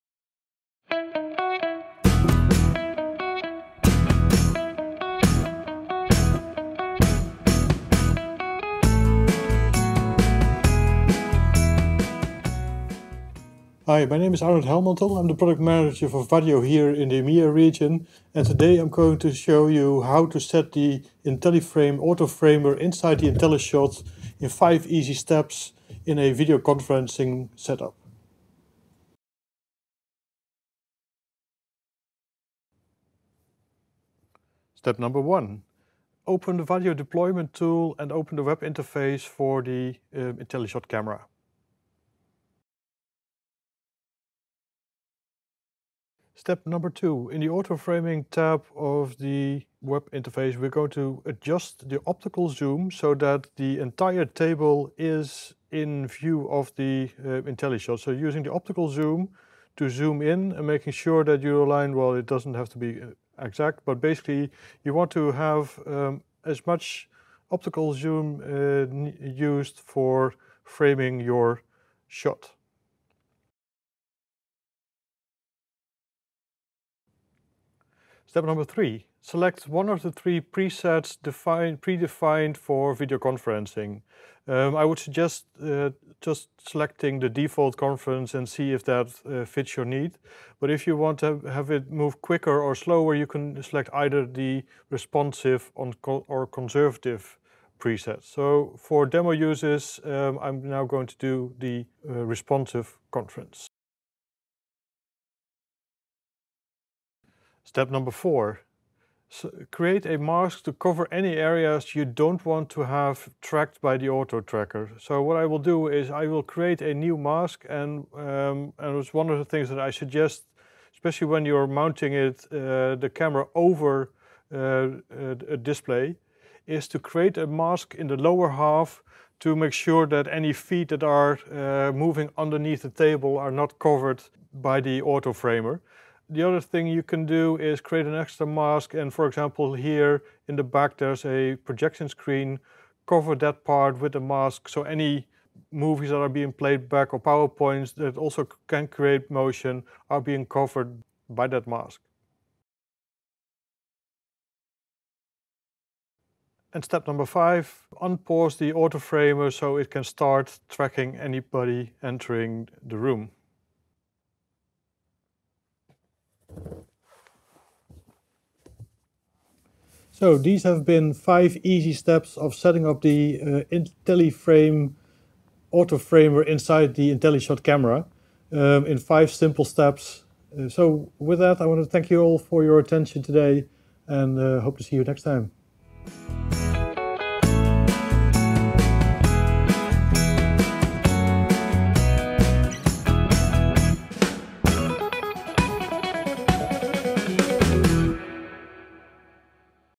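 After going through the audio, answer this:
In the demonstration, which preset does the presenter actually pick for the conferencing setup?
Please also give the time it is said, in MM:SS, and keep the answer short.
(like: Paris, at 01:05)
responsive conference, at 01:42.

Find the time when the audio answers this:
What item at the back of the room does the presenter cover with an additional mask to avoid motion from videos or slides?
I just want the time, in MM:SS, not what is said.
02:21.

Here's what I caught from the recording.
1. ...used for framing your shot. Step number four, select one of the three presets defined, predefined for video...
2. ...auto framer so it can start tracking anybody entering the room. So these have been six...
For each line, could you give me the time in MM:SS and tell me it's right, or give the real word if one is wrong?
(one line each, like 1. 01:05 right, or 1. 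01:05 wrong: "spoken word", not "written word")
1. 01:09 wrong: "three", not "four"
2. 02:38 wrong: "five", not "six".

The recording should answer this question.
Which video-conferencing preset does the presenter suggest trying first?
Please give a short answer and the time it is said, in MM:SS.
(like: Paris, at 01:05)
default conference, at 01:27.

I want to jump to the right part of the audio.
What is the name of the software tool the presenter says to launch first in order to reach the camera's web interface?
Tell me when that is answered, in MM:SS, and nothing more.
00:36.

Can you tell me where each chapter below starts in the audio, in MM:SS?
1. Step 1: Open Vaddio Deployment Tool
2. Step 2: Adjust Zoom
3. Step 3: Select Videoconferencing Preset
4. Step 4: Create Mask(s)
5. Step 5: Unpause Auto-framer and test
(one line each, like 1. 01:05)
1. 00:26
2. 00:43
3. 01:14
4. 01:44
5. 02:33.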